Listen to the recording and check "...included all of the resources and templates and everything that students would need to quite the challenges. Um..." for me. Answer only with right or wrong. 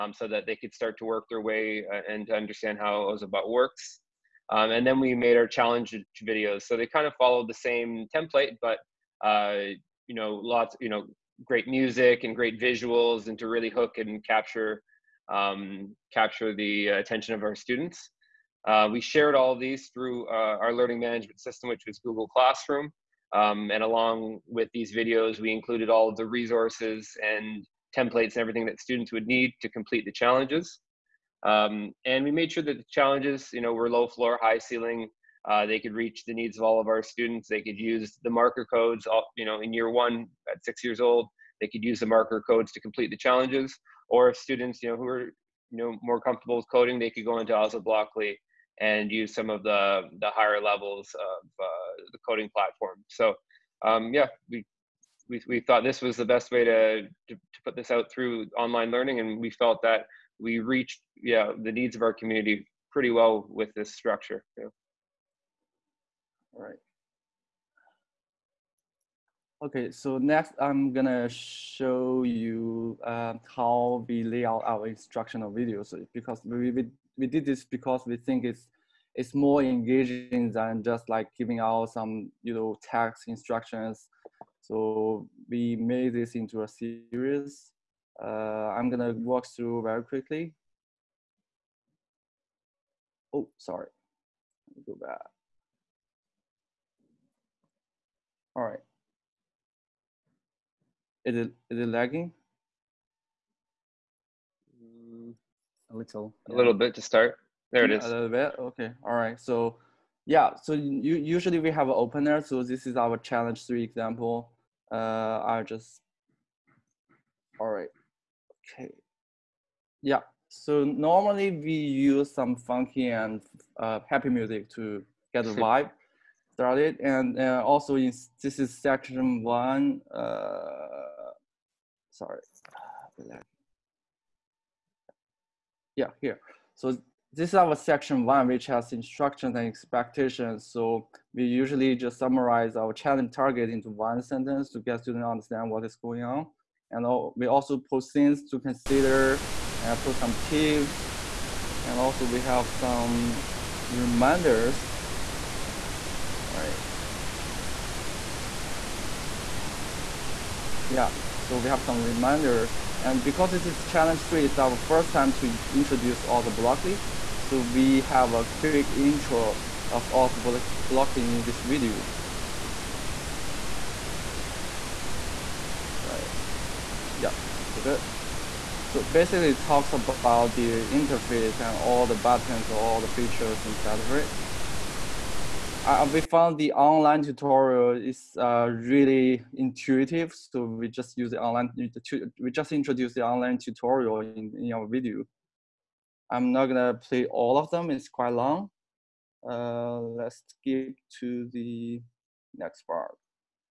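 wrong.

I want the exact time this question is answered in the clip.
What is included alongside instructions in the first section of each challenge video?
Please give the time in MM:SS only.
02:19.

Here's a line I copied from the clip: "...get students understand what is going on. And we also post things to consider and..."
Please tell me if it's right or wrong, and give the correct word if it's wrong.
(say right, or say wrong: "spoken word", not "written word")
right.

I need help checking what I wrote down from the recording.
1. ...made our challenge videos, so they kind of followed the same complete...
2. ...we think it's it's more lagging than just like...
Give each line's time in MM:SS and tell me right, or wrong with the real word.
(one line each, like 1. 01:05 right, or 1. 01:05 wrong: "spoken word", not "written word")
1. 00:05 wrong: "template", not "complete"
2. 01:18 wrong: "engaging", not "lagging".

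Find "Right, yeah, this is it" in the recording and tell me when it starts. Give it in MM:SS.
02:56.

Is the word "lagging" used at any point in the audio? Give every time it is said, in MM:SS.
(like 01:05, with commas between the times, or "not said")
01:41.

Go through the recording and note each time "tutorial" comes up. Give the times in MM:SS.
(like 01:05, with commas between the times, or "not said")
03:07, 03:13.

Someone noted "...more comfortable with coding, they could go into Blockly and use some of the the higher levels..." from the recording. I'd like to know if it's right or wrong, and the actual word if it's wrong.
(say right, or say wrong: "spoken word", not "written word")
wrong: "Ozoblockly", not "Blockly".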